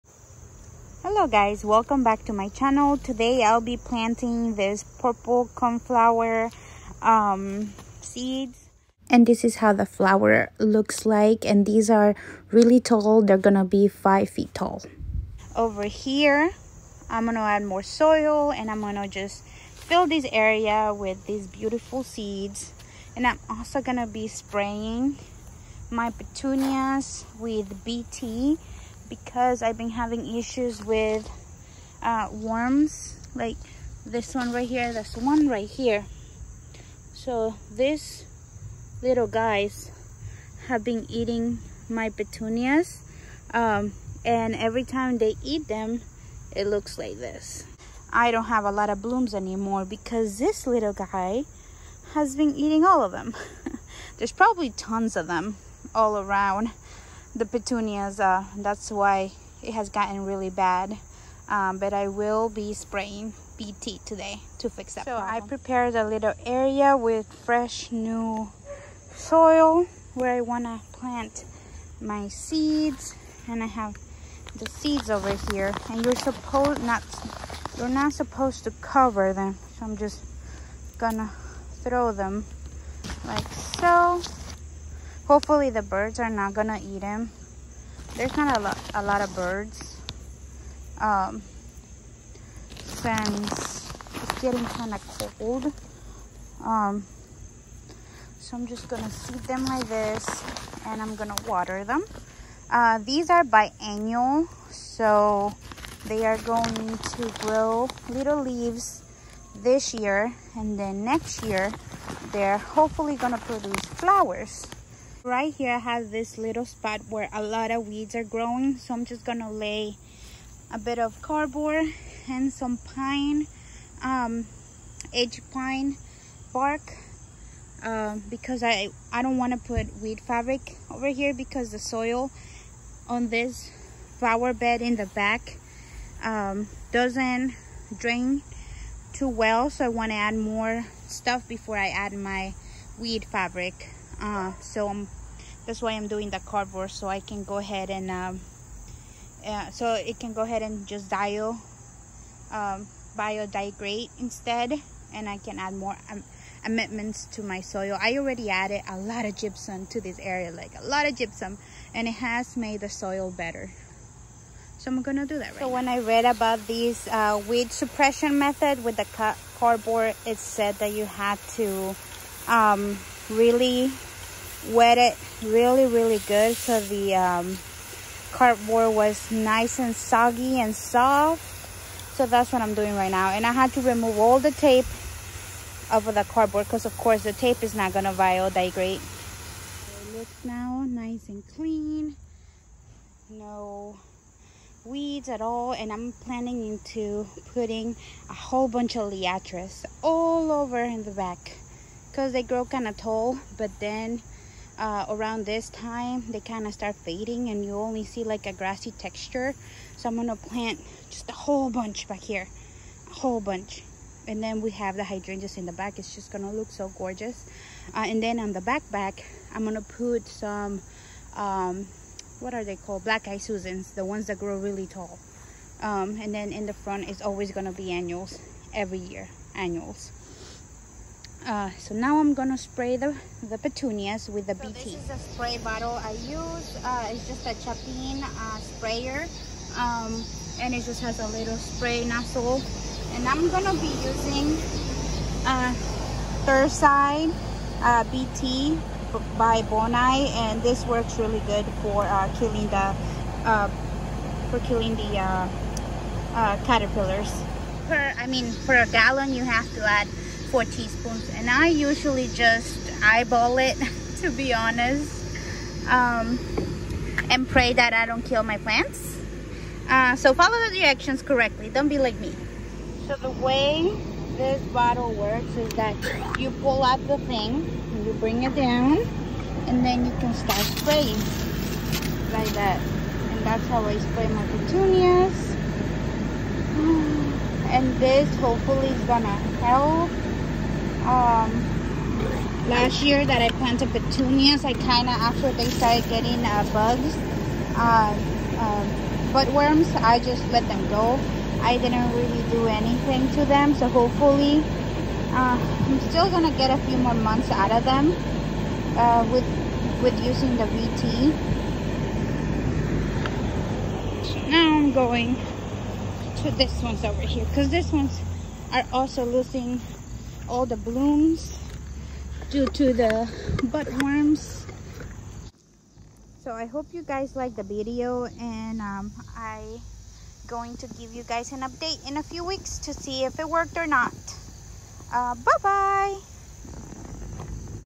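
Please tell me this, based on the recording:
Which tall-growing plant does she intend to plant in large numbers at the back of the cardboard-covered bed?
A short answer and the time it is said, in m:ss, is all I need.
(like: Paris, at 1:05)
Liatris, at 3:19.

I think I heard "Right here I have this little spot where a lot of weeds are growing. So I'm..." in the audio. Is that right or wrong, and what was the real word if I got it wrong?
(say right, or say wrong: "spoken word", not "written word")
right.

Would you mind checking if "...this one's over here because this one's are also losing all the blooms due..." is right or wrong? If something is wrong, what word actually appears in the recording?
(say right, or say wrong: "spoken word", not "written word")
right.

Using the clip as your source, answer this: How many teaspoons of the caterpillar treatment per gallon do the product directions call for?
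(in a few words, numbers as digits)
4.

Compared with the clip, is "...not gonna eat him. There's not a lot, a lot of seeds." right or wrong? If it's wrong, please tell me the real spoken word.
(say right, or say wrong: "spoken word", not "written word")
wrong: "birds", not "seeds".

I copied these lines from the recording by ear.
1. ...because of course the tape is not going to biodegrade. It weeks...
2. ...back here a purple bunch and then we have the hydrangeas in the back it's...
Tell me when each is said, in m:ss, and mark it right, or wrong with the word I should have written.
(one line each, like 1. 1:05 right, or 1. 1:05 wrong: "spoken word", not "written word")
1. 3:06 wrong: "looks", not "weeks"
2. 3:32 wrong: "whole", not "purple".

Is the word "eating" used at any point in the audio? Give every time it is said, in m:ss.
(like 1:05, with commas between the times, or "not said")
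0:41, 0:52.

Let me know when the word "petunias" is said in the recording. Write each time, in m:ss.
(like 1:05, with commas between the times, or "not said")
0:26, 0:42, 0:57, 3:53, 4:44, 4:53.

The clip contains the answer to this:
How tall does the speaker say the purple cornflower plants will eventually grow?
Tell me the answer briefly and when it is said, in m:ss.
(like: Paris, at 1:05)
5 feet, at 0:13.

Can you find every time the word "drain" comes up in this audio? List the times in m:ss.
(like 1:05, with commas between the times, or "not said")
2:17.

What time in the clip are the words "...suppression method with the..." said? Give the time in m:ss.
2:47.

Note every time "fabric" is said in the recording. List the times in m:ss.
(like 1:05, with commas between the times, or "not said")
2:10, 2:23.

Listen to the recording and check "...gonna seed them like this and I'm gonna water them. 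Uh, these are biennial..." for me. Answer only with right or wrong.
right.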